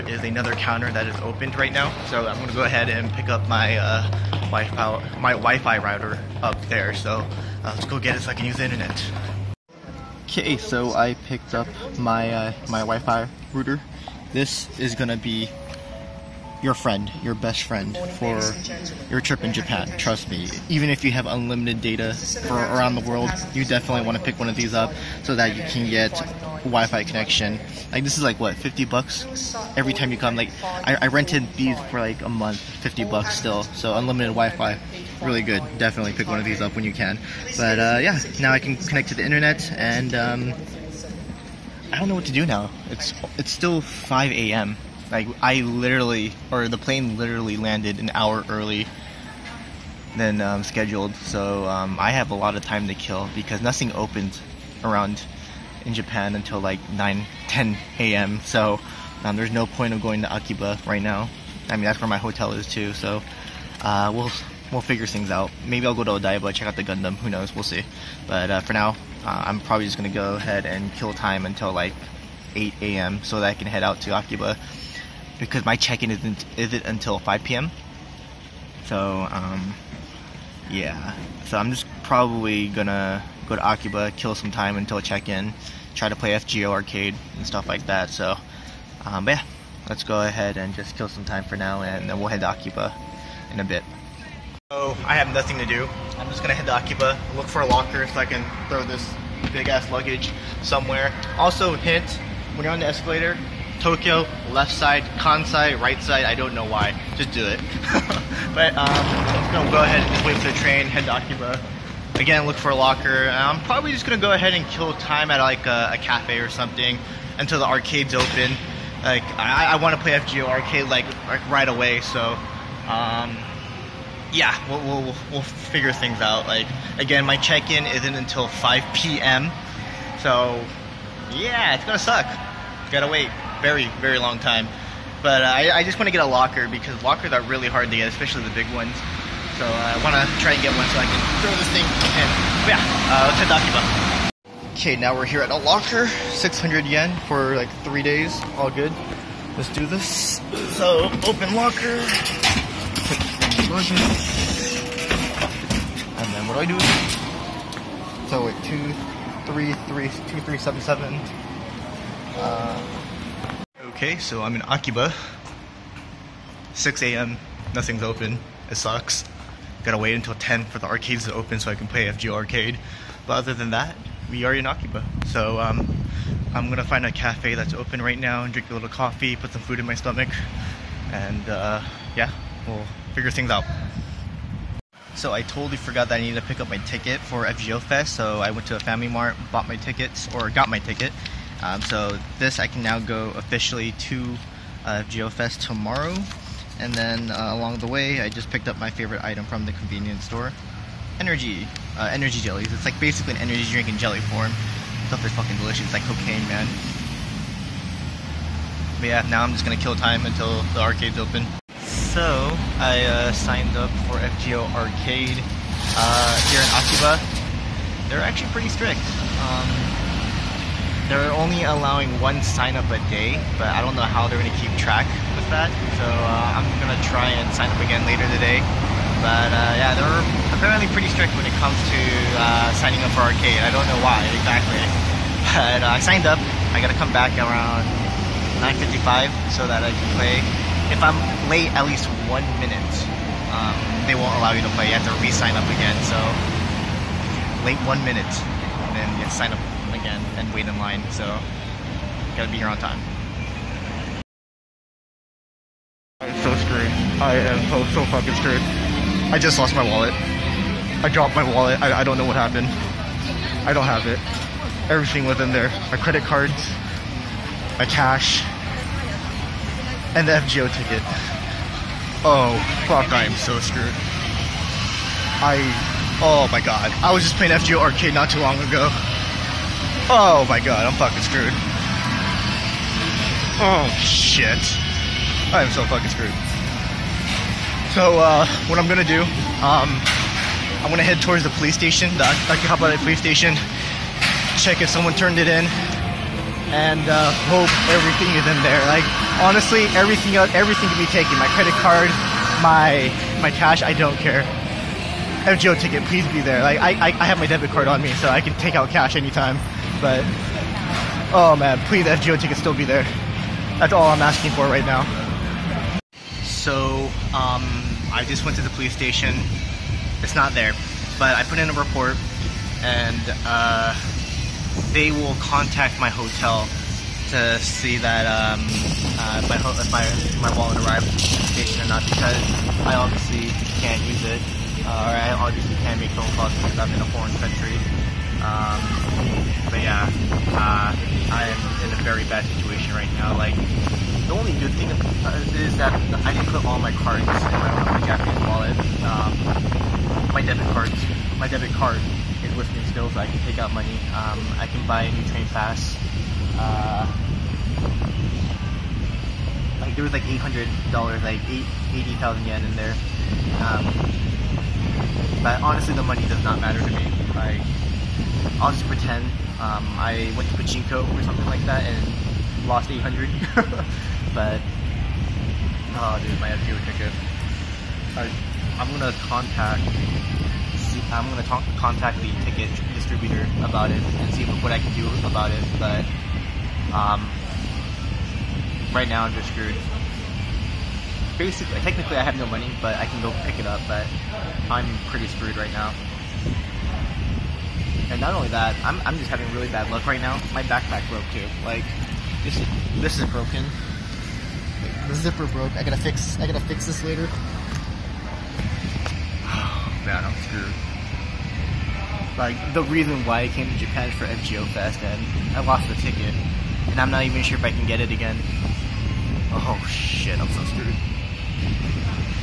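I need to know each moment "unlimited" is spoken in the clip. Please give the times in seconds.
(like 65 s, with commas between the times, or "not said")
21 s, 33 s.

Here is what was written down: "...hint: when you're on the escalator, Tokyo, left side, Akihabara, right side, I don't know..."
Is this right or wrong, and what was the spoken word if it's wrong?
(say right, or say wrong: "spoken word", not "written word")
wrong: "Kansai", not "Akihabara".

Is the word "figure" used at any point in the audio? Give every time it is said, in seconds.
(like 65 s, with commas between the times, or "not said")
64 s, 125 s, 183 s.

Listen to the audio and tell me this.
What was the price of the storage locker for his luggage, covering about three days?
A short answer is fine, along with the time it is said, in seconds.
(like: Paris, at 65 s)
600 yen, at 146 s.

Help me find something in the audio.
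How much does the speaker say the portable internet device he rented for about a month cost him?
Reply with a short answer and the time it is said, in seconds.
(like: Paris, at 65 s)
50 bucks, at 32 s.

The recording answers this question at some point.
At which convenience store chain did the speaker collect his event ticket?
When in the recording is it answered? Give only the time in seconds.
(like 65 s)
188 s.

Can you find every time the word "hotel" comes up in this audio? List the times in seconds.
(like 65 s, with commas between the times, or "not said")
62 s, 326 s.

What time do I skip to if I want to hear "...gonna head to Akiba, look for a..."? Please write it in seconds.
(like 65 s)
96 s.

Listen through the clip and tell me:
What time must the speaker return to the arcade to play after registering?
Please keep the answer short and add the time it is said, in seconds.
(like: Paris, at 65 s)
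9:55, at 238 s.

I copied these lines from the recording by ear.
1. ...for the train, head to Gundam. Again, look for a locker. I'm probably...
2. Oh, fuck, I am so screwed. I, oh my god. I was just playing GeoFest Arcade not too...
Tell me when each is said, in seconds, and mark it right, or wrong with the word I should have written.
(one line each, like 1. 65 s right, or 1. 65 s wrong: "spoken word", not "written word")
1. 110 s wrong: "Akiba", not "Gundam"
2. 272 s wrong: "FGO", not "GeoFest".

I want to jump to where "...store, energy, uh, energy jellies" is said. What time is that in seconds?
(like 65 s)
200 s.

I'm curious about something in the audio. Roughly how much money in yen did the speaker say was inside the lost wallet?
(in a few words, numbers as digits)
80,000 yen.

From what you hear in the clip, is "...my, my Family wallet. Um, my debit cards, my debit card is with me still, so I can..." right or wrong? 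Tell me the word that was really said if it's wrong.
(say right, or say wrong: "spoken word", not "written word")
wrong: "Japanese", not "Family".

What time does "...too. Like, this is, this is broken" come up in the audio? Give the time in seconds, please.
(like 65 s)
401 s.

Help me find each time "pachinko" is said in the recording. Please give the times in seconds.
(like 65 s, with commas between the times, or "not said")
370 s.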